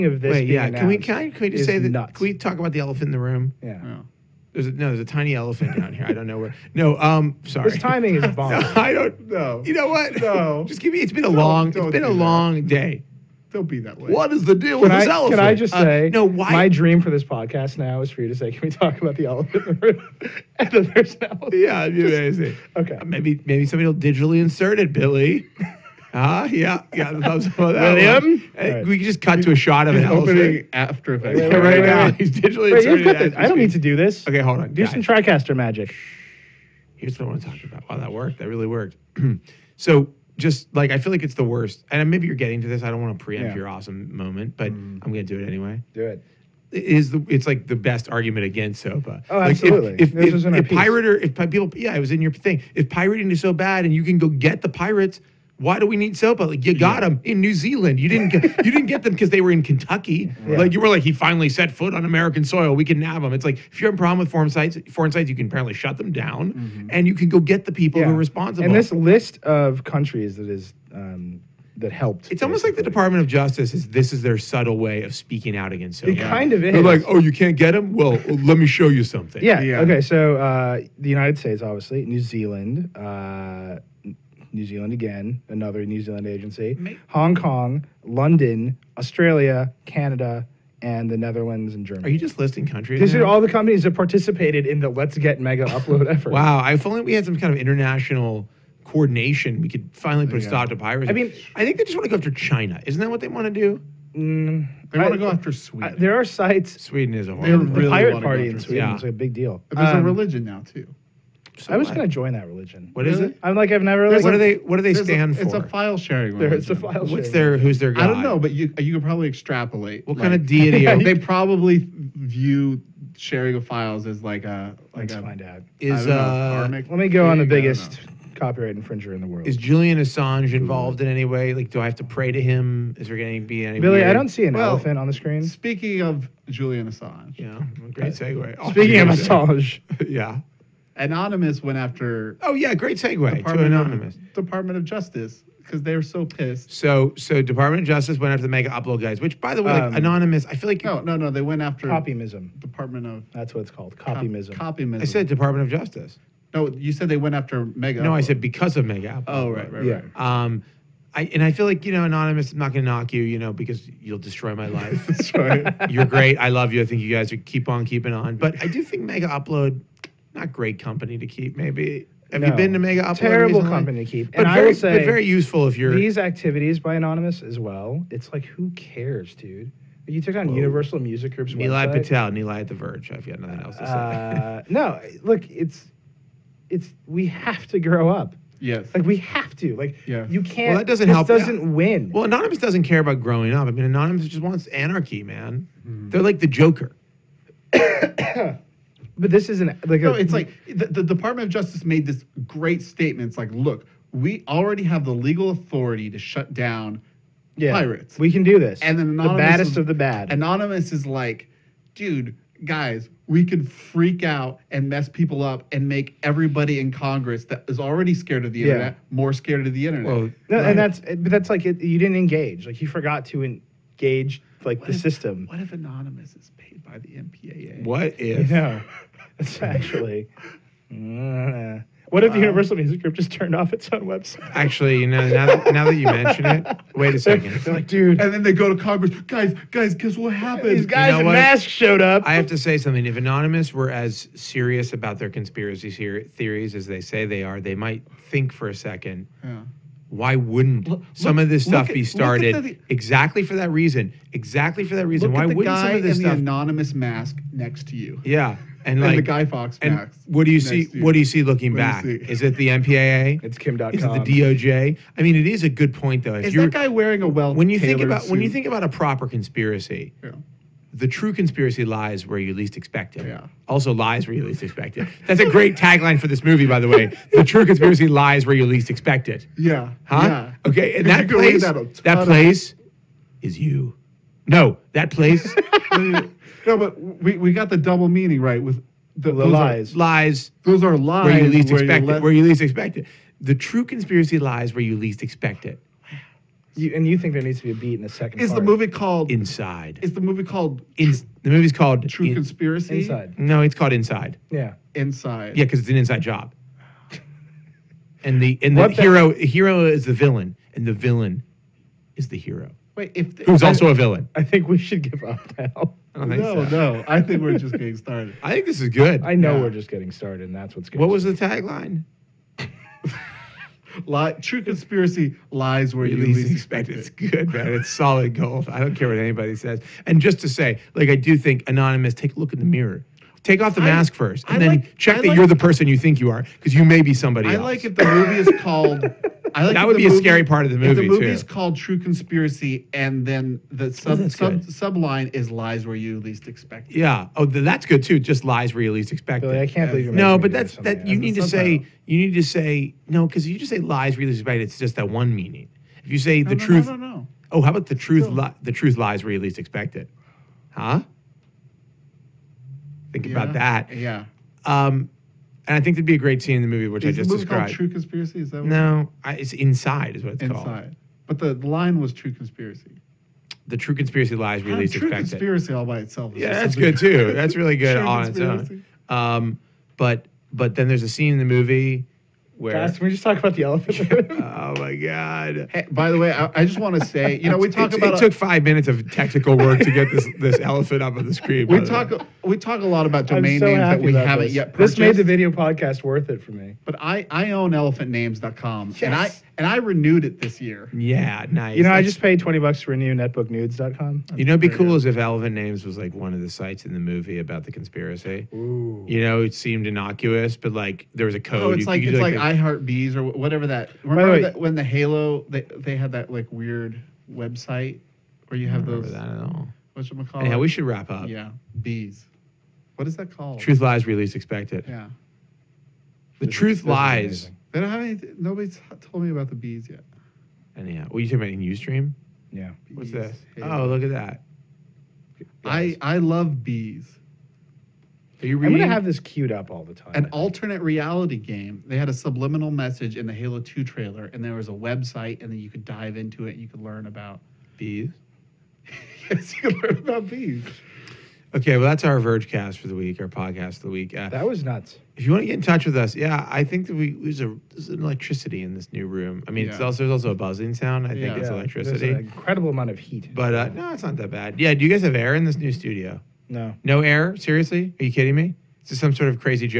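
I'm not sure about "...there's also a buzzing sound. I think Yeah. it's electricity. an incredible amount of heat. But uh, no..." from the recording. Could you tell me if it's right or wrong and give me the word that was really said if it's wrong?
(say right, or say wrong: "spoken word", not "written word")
right.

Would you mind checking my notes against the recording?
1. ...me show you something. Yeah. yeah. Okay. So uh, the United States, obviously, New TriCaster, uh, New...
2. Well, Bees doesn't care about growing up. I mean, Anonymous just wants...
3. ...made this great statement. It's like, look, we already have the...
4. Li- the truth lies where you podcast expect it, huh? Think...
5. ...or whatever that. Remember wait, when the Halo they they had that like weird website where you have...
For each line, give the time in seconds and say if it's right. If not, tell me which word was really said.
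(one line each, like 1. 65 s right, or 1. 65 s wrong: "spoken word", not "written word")
1. 78 s wrong: "Zealand", not "TriCaster"
2. 192 s wrong: "Anonymous", not "Bees"
3. 201 s right
4. 358 s wrong: "least", not "podcast"
5. 413 s right.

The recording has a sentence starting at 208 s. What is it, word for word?
And then anonymous the baddest is, of the bad.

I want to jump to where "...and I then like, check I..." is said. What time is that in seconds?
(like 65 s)
334 s.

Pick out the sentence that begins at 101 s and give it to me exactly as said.
I mean, I think they just want to go after China.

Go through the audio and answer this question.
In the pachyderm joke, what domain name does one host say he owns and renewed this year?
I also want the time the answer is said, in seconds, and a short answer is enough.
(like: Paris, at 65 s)
elephantnames.com, at 397 s.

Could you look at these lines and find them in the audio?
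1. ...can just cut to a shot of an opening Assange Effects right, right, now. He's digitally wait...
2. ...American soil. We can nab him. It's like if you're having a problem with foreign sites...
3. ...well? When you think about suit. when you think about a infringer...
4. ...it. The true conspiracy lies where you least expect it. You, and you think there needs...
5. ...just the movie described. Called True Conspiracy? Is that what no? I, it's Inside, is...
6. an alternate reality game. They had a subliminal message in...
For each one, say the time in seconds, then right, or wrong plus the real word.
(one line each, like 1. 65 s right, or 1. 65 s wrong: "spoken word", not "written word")
1. 28 s wrong: "After", not "Assange"
2. 62 s right
3. 267 s wrong: "proper", not "infringer"
4. 292 s right
5. 367 s right
6. 440 s right.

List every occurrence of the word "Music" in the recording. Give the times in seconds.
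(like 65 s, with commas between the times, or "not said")
180 s, 232 s.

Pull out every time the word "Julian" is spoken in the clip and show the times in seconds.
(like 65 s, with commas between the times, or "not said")
129 s, 136 s.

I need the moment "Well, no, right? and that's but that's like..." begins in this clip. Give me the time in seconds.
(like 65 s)
220 s.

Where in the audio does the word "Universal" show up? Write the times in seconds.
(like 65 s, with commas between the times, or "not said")
180 s, 232 s.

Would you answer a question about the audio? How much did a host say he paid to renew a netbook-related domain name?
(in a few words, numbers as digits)
$20.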